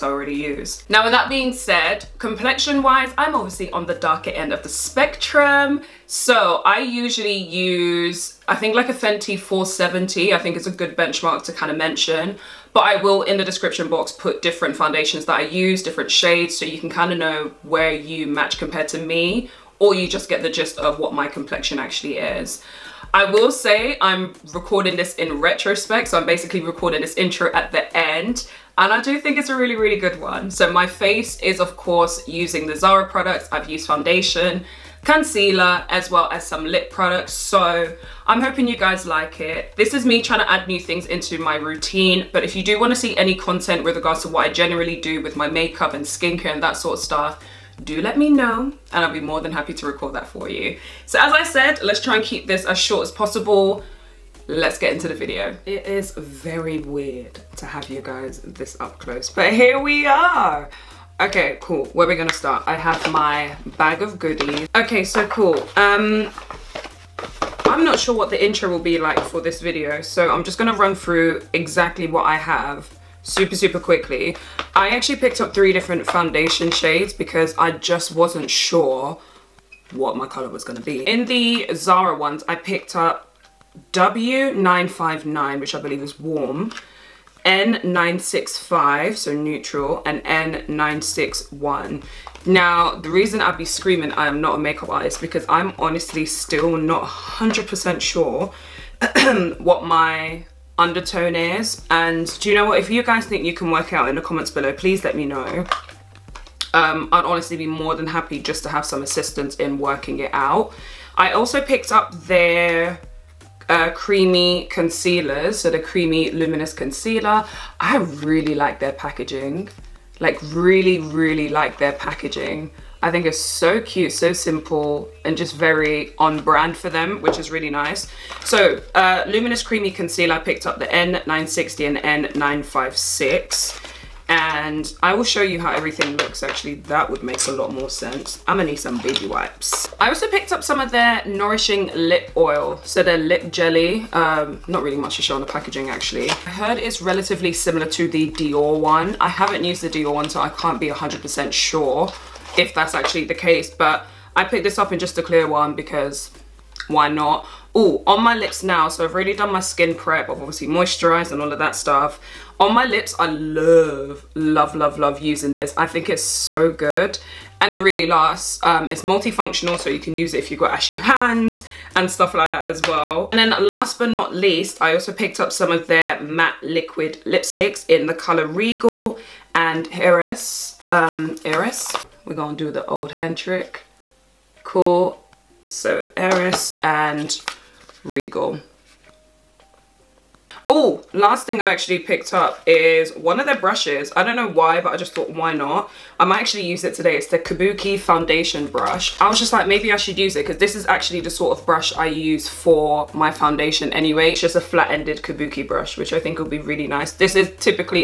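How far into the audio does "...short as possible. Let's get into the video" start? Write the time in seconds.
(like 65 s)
52 s.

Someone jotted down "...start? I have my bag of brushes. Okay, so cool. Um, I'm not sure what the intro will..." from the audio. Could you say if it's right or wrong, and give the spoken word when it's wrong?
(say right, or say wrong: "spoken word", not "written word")
wrong: "goodies", not "brushes".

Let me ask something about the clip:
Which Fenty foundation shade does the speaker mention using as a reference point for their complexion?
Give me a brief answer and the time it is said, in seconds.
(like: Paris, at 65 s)
470, at 9 s.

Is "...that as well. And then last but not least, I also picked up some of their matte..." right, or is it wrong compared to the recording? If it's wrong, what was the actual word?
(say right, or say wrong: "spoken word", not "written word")
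right.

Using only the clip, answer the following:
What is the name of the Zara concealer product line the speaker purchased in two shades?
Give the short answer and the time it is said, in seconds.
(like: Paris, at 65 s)
Luminous Creamy Concealer, at 129 s.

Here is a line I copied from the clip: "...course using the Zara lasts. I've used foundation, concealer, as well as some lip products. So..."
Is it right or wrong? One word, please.
wrong.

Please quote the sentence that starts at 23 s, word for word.
I will say I'm recording this in retrospect, so I'm basically recording this intro at the end.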